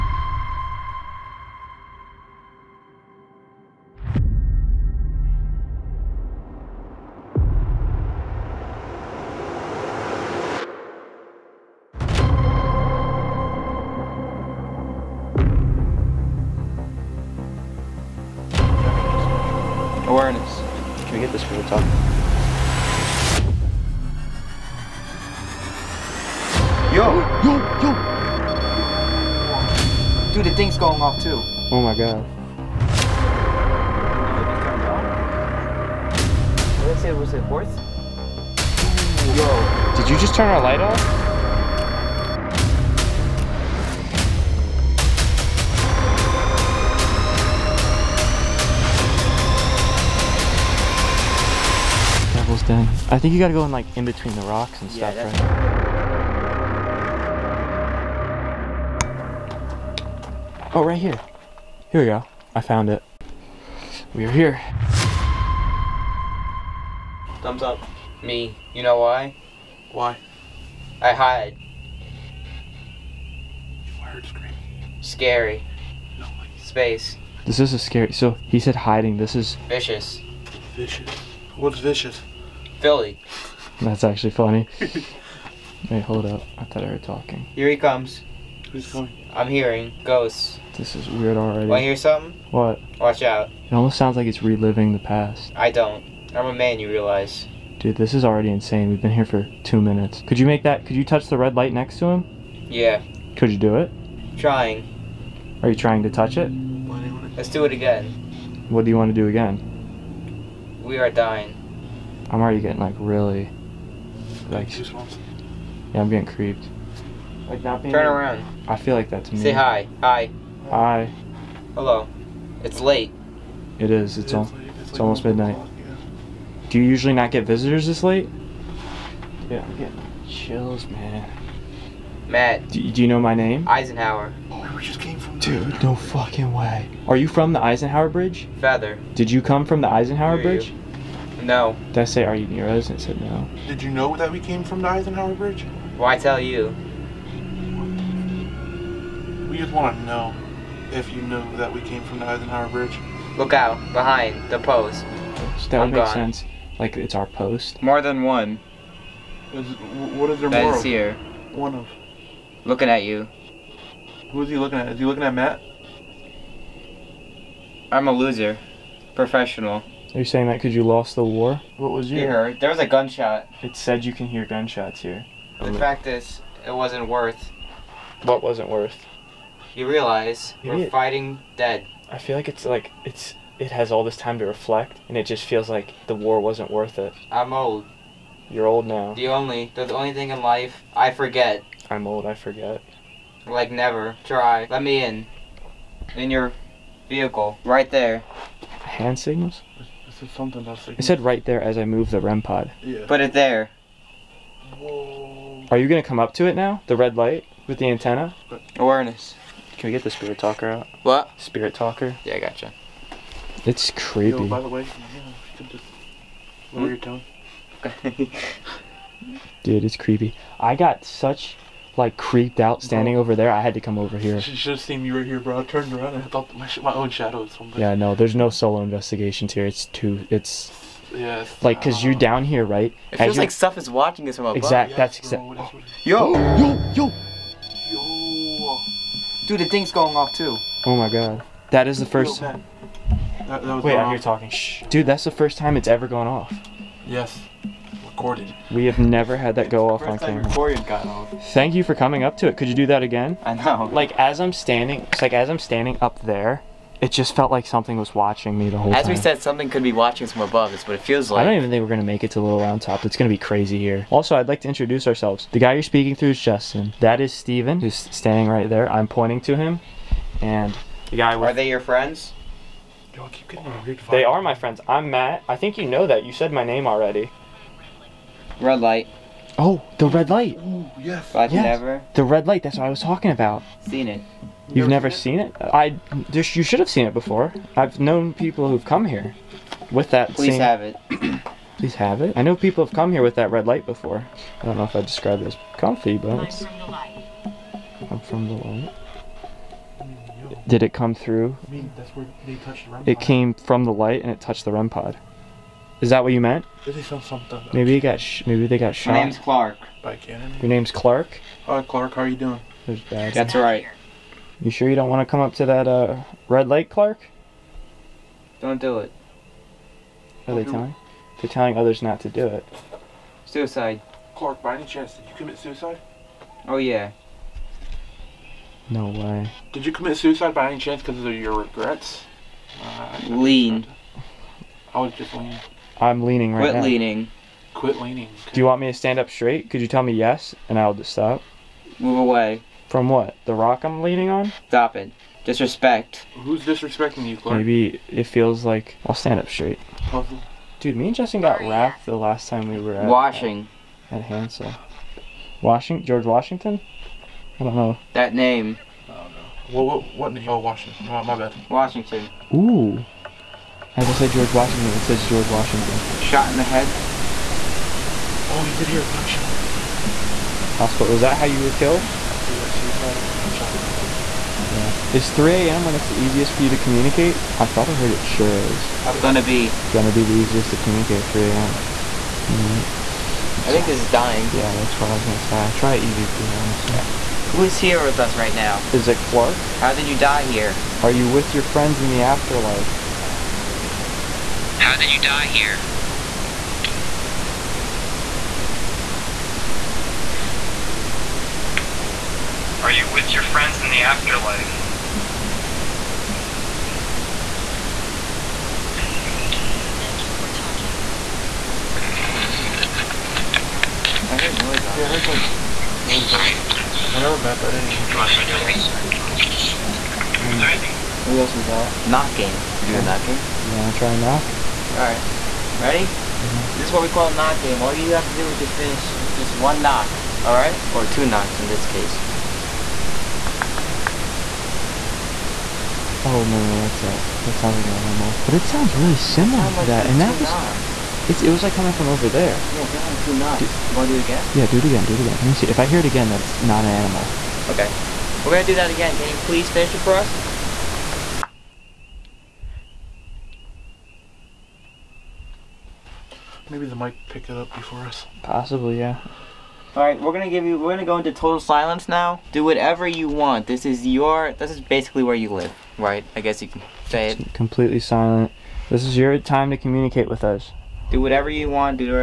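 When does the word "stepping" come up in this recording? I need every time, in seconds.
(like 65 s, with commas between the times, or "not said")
not said.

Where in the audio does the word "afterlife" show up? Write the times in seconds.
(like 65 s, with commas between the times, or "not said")
392 s, 408 s.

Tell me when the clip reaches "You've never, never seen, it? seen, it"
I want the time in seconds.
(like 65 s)
284 s.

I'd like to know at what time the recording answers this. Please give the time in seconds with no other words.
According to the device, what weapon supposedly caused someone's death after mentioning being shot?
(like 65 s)
310 s.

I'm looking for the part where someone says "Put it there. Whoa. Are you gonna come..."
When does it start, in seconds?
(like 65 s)
203 s.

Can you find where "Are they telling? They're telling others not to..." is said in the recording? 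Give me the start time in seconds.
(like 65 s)
320 s.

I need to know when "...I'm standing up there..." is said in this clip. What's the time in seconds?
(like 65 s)
255 s.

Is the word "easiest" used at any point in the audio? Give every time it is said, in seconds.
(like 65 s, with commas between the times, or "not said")
376 s, 380 s.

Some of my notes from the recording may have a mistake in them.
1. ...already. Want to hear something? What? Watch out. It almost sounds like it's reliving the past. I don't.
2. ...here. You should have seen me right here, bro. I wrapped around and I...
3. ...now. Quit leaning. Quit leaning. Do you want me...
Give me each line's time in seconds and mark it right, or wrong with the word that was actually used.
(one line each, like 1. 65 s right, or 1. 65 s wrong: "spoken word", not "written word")
1. 91 s right
2. 224 s wrong: "turned", not "wrapped"
3. 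336 s right.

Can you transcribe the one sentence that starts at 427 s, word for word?
All you have to do is just finish with just one knock.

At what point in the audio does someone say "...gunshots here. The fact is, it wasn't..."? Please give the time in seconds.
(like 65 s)
174 s.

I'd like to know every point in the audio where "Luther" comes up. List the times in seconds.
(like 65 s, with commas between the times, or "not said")
not said.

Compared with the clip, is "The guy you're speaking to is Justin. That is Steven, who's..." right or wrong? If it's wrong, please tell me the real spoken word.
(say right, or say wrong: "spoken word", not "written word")
right.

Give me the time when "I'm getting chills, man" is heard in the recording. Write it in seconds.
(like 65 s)
129 s.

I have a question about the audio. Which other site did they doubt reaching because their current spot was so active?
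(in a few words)
Little Round Top.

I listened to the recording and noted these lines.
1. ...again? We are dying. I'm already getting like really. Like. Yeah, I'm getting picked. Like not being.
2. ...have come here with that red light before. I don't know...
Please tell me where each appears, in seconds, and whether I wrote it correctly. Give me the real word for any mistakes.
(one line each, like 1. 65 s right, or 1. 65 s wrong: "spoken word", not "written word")
1. 109 s wrong: "creeped", not "picked"
2. 292 s right.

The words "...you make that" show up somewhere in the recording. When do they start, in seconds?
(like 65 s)
100 s.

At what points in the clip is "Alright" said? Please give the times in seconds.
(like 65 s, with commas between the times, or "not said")
424 s, 430 s.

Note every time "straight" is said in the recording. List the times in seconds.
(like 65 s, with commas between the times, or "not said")
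339 s, 349 s.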